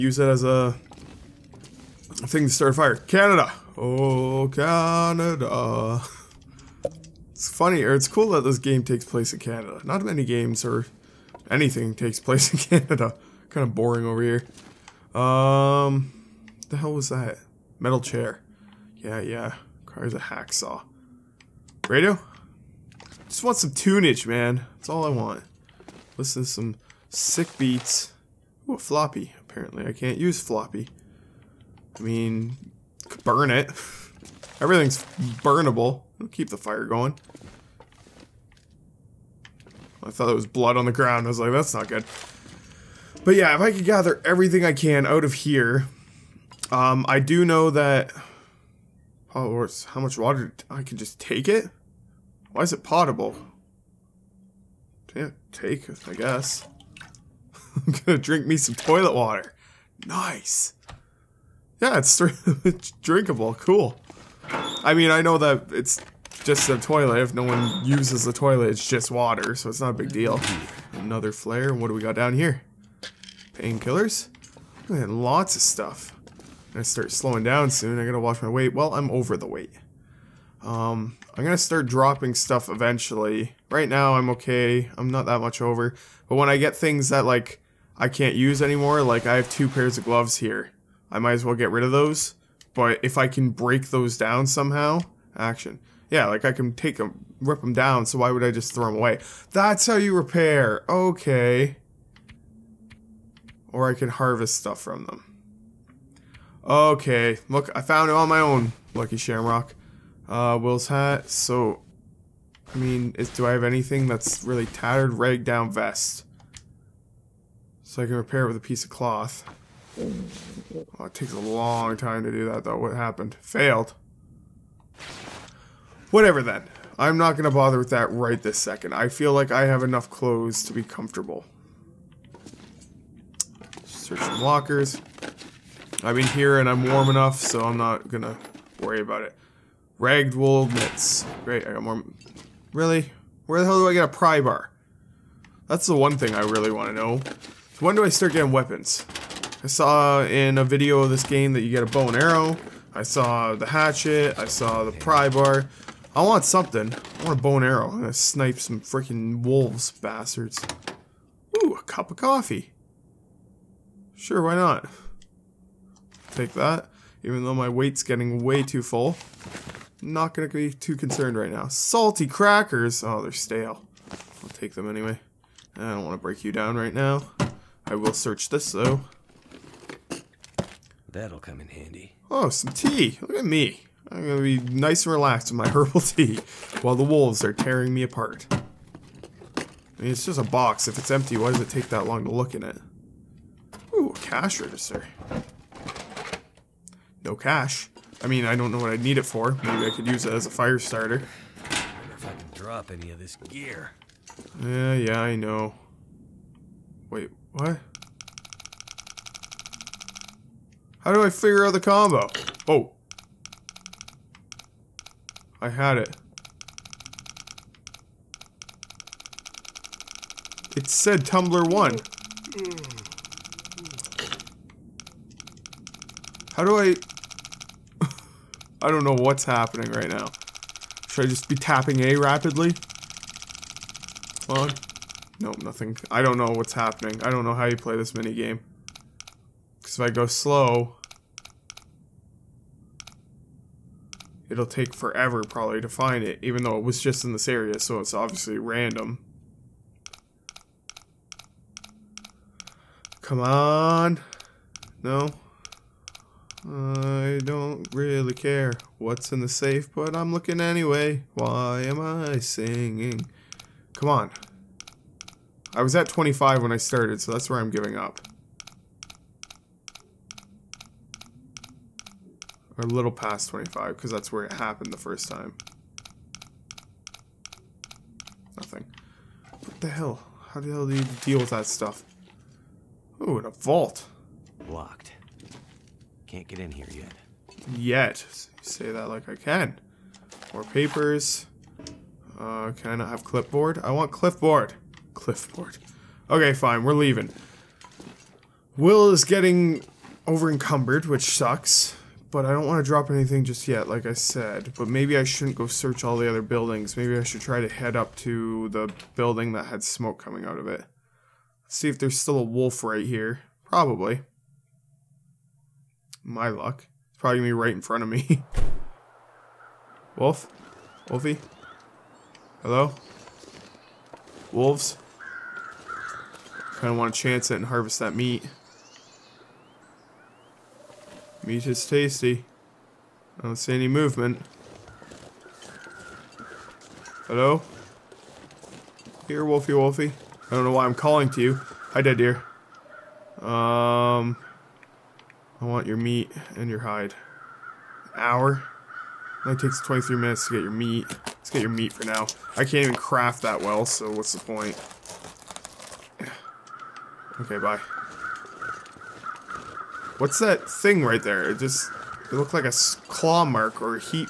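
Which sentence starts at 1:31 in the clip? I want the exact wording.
I might as well get rid of those.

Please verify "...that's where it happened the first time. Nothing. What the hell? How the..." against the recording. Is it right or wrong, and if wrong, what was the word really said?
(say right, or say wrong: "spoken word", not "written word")
right.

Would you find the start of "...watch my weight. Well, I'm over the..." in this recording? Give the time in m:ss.
1:18.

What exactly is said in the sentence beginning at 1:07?
If no one uses the toilet, it's just water, so it's not a big deal.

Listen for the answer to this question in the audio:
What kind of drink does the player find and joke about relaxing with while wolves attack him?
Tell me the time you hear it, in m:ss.
3:05.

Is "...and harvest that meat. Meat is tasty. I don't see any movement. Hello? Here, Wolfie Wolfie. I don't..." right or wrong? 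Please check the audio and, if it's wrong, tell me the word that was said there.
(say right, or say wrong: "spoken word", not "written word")
right.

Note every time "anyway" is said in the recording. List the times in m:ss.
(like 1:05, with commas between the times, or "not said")
2:54, 4:20.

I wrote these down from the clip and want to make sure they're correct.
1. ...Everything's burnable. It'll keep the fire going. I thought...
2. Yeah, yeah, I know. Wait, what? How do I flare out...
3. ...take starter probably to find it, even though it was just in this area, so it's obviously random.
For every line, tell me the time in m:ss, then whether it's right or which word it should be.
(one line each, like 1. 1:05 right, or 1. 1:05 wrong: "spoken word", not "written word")
1. 0:34 right
2. 3:24 wrong: "figure", not "flare"
3. 4:04 wrong: "forever", not "starter".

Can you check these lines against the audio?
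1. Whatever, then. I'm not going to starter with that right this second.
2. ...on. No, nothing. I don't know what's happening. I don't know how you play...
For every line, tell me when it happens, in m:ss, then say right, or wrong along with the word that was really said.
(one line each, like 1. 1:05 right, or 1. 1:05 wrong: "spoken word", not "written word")
1. 2:06 wrong: "bother", not "starter"
2. 3:54 right.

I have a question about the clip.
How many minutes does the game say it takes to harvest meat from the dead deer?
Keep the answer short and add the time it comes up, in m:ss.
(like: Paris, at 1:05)
23, at 5:49.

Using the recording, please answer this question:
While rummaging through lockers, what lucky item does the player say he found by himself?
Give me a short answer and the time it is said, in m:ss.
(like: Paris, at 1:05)
Lucky Shamrock, at 1:48.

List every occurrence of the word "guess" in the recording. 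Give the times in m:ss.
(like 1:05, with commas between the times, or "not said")
0:56.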